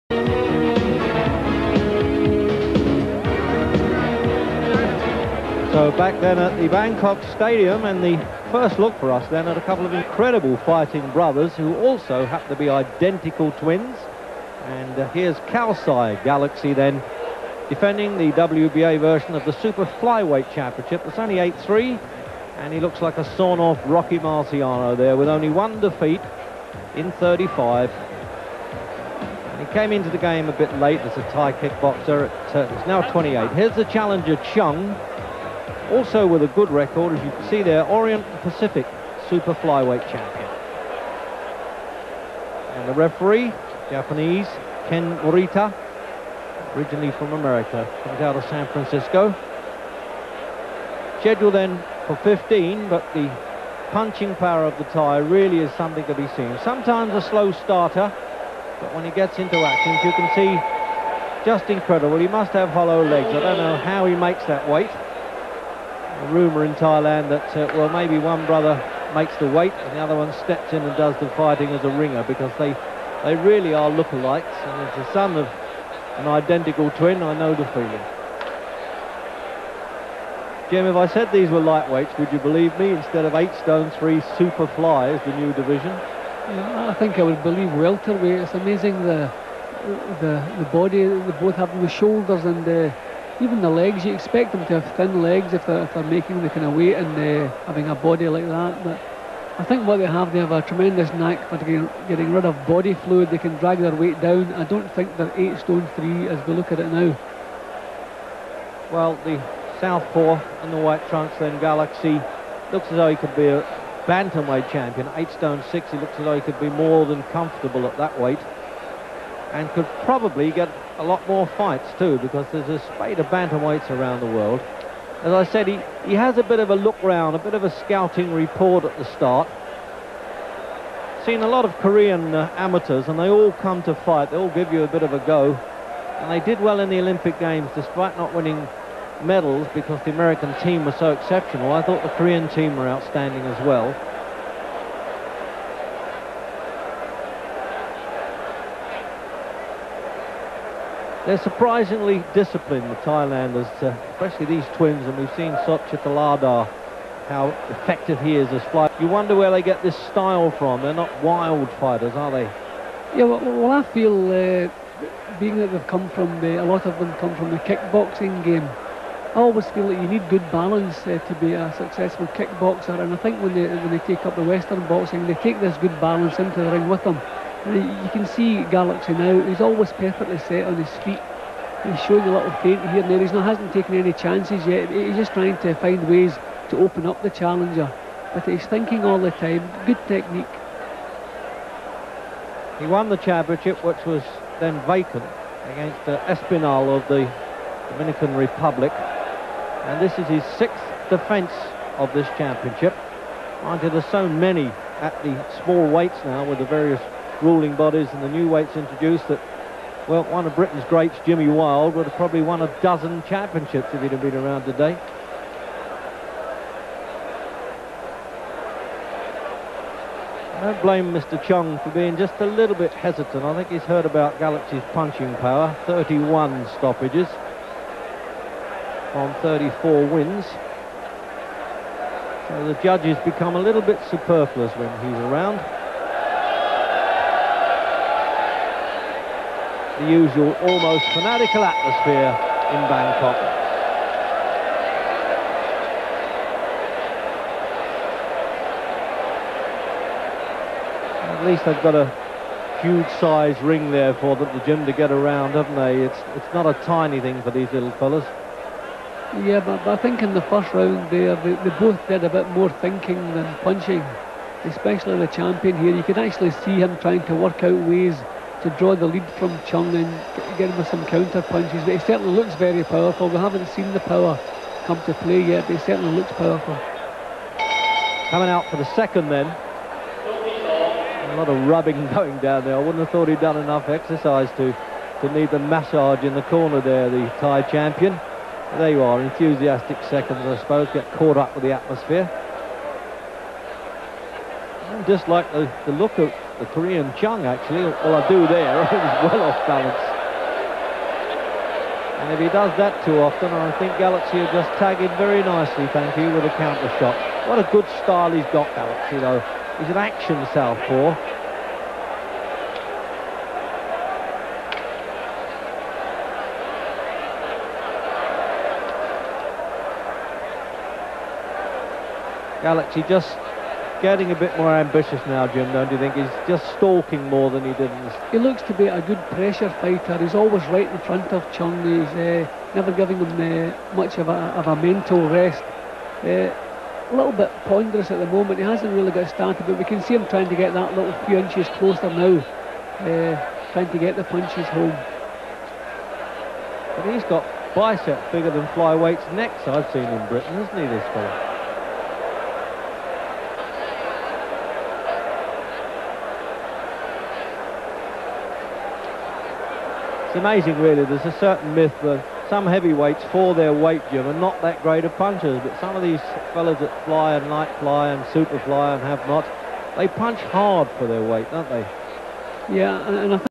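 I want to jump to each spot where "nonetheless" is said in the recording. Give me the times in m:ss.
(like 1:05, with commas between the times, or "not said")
not said.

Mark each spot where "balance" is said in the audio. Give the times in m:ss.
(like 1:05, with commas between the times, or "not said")
2:50, 2:56, 4:59.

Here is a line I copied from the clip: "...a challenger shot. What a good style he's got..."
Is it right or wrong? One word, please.
wrong.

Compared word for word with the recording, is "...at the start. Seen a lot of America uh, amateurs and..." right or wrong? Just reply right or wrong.
wrong.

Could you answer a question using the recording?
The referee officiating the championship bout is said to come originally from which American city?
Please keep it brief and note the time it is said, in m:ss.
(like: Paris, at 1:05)
San Francisco, at 0:48.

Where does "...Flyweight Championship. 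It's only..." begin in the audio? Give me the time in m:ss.
0:19.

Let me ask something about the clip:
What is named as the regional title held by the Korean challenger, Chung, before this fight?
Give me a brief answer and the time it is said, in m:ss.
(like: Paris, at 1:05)
Orient Pacific Super Flyweight Champion, at 0:37.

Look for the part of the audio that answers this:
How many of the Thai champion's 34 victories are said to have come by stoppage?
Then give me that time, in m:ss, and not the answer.
3:45.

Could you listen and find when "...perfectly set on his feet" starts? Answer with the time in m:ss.
2:59.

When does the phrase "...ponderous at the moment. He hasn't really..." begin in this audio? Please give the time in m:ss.
5:37.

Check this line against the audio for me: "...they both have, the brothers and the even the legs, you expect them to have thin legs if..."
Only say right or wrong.
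wrong.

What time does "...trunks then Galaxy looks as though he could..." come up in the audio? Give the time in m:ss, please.
1:51.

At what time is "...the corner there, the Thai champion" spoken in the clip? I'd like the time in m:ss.
4:46.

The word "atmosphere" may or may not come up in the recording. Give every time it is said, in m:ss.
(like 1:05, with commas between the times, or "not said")
4:01, 4:51.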